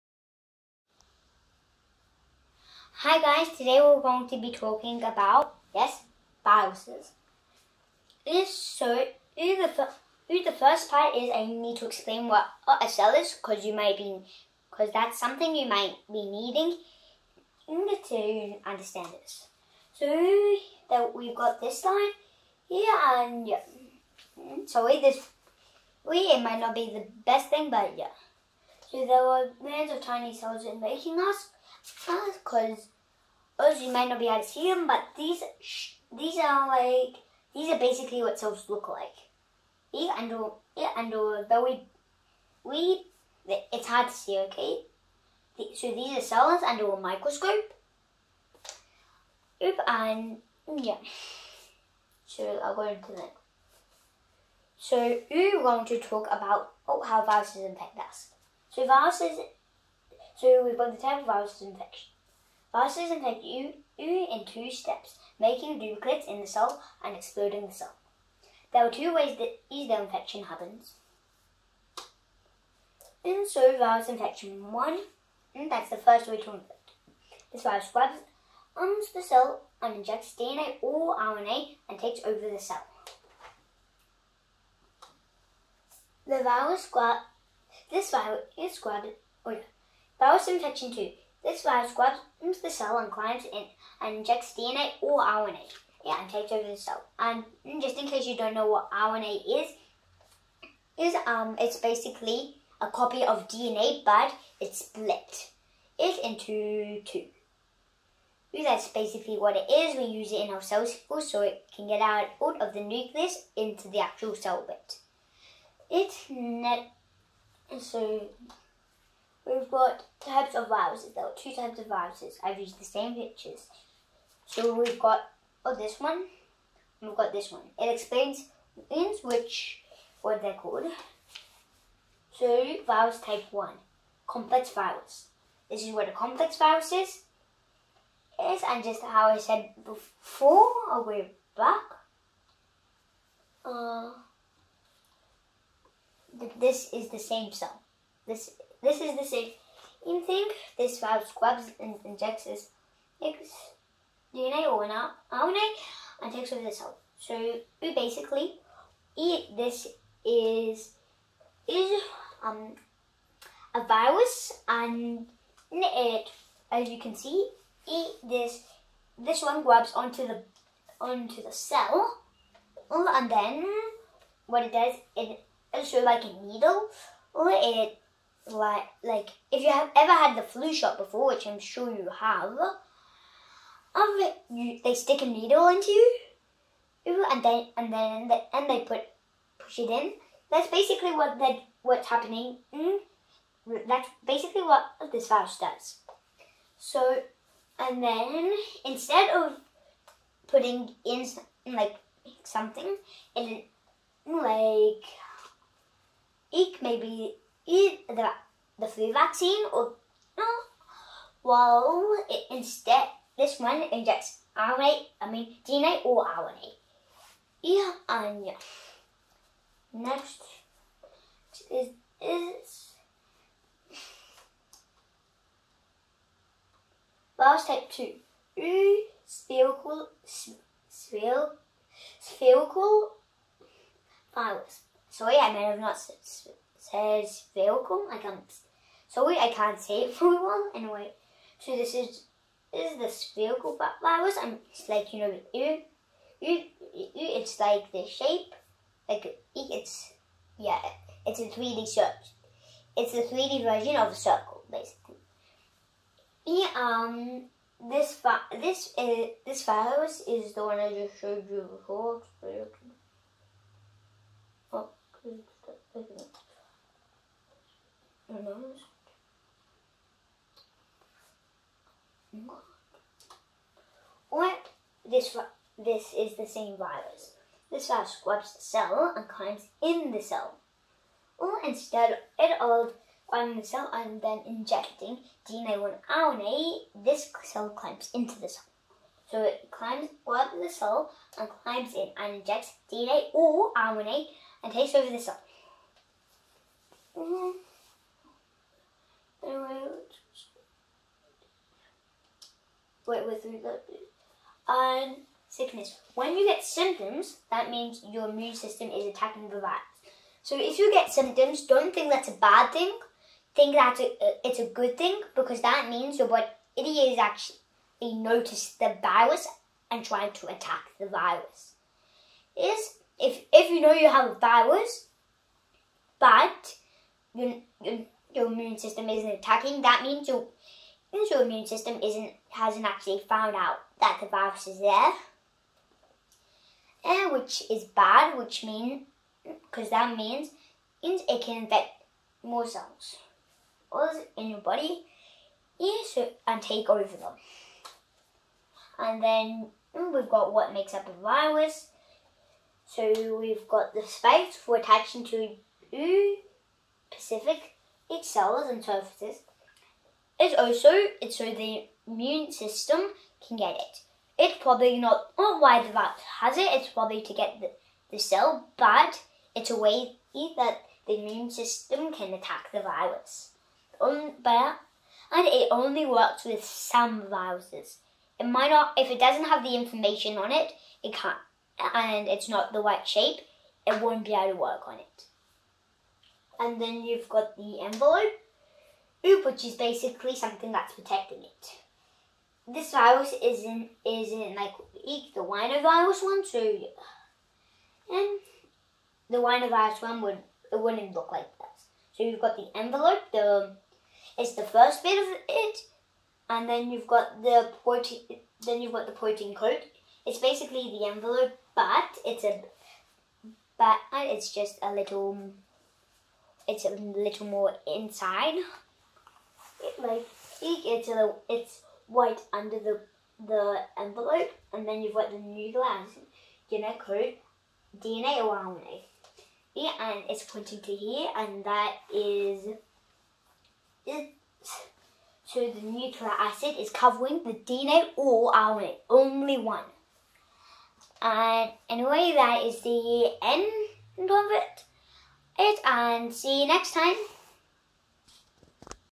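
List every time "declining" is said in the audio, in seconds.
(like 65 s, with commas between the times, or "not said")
not said.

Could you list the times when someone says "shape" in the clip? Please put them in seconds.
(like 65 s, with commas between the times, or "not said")
248 s, 383 s.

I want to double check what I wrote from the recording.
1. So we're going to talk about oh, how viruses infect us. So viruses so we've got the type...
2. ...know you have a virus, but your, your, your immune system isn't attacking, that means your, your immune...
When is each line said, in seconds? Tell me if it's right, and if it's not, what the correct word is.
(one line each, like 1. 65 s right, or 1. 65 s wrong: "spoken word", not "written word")
1. 54 s right
2. 323 s right.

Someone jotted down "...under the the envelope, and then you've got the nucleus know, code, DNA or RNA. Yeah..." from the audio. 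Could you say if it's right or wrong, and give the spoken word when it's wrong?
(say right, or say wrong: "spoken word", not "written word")
right.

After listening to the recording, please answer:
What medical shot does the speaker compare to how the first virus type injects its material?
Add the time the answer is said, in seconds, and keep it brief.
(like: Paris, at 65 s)
the flu shot, at 180 s.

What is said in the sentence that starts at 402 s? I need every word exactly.
So you've got the envelope, the it's the first bit of it, and then you've got the protein.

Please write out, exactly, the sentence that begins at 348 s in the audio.
And then mm, we've got what makes up a virus.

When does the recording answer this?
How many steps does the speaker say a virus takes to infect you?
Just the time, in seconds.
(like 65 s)
64 s.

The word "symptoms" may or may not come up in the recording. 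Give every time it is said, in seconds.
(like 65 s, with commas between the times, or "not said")
306 s, 311 s.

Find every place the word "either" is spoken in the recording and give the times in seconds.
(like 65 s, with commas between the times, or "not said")
9 s, 69 s.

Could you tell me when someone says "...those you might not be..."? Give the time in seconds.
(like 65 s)
33 s.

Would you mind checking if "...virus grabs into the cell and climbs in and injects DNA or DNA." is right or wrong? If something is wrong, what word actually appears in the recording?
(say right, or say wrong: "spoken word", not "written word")
wrong: "RNA", not "DNA".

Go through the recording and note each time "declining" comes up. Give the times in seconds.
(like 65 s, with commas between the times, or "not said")
not said.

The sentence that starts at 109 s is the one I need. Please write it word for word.
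We use it in our cell cycle so it can get out out of the nucleus into the actual cell bit.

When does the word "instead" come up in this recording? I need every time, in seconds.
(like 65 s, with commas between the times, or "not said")
198 s, 212 s, 281 s.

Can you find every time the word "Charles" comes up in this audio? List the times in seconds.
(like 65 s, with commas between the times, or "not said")
not said.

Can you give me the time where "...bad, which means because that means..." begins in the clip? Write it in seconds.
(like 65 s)
337 s.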